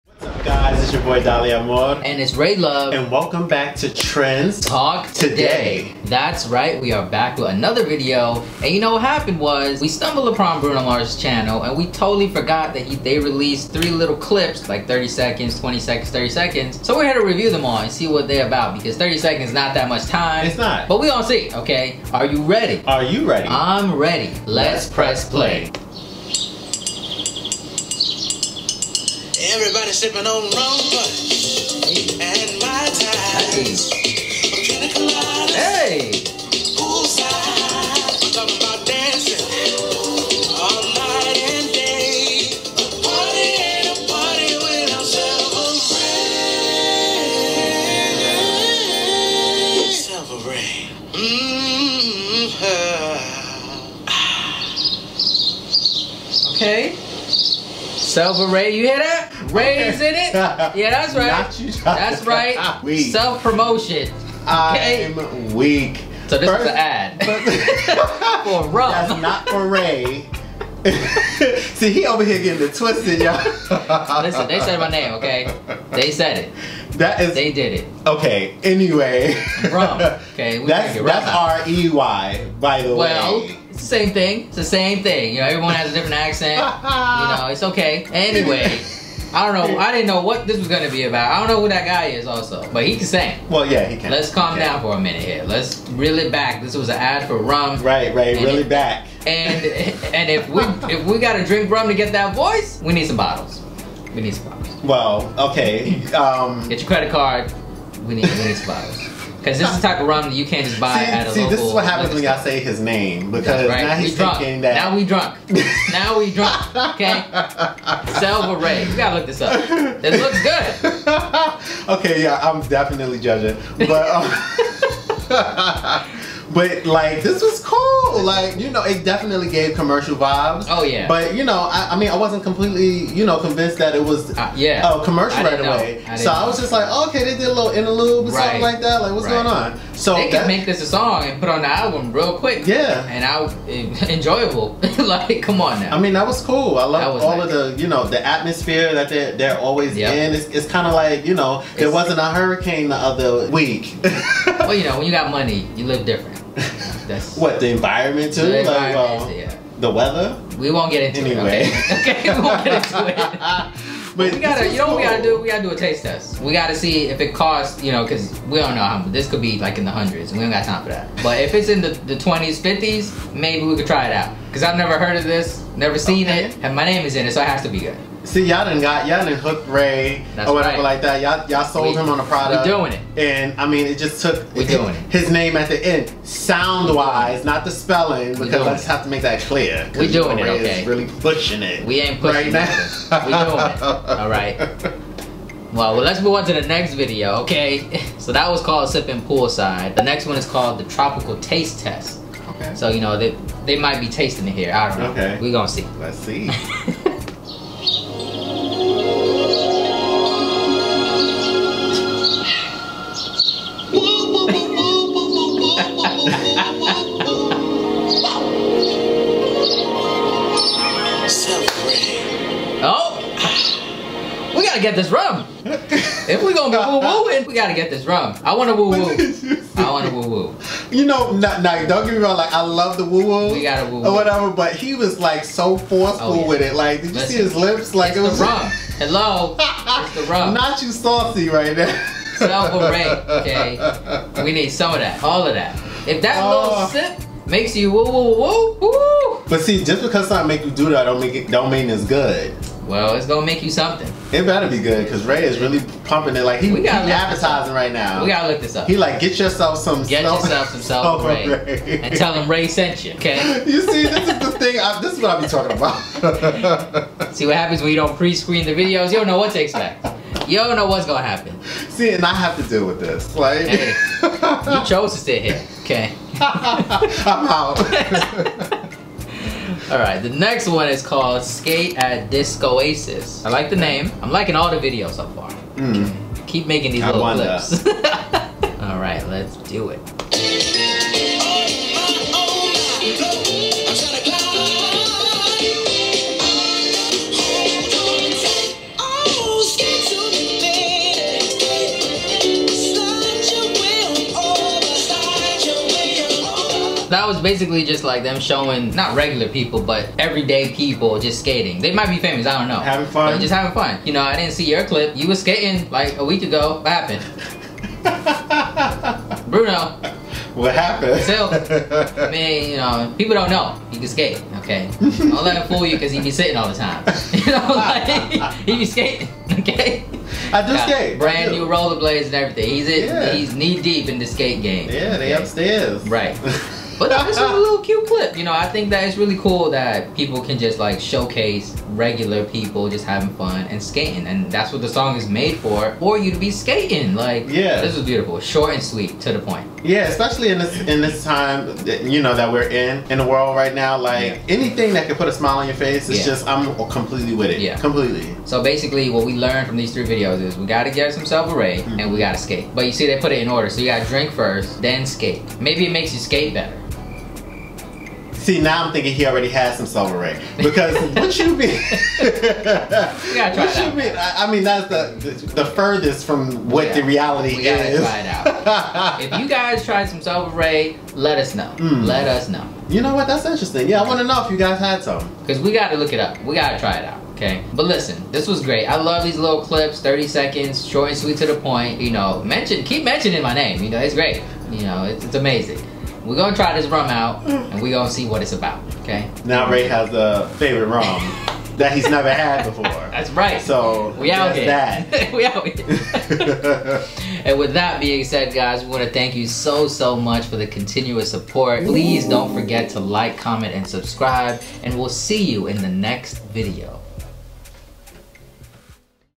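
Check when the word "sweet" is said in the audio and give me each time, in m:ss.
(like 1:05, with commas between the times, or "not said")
5:48, 6:31.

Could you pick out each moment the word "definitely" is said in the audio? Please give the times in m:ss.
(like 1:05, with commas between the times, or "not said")
2:02, 2:09.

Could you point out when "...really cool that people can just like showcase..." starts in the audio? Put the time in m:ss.
5:39.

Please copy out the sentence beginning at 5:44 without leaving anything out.
And that's what the song is made for, for you to be skating.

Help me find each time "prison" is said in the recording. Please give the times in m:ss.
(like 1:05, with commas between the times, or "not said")
not said.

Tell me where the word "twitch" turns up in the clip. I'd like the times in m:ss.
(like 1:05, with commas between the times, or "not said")
not said.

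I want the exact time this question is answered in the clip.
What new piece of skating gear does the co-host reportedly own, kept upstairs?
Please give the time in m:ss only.
5:31.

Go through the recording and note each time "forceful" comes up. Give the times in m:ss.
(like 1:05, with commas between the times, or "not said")
3:55.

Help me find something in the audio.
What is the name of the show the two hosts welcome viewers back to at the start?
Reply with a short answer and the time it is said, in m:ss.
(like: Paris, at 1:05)
Trends Talk Today, at 0:03.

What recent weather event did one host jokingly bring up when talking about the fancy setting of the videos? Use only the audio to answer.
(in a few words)
a hurricane.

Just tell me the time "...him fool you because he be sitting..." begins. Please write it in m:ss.
5:25.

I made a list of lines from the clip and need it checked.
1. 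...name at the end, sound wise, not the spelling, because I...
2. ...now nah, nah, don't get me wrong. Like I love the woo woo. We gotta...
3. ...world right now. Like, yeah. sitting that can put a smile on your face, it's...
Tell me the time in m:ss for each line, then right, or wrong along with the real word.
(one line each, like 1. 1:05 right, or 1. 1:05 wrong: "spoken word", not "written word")
1. 3:05 right
2. 3:51 right
3. 5:53 wrong: "anything", not "sitting".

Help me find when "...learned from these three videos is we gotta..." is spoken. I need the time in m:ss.
5:59.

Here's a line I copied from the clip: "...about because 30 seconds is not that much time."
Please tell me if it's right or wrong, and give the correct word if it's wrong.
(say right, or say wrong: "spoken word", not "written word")
right.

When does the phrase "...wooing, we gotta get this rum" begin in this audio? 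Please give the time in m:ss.
3:46.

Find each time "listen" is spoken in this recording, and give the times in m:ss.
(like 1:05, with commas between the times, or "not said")
1:14, 3:57, 6:27.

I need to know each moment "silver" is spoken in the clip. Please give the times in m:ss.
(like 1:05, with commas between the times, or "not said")
6:09, 6:20.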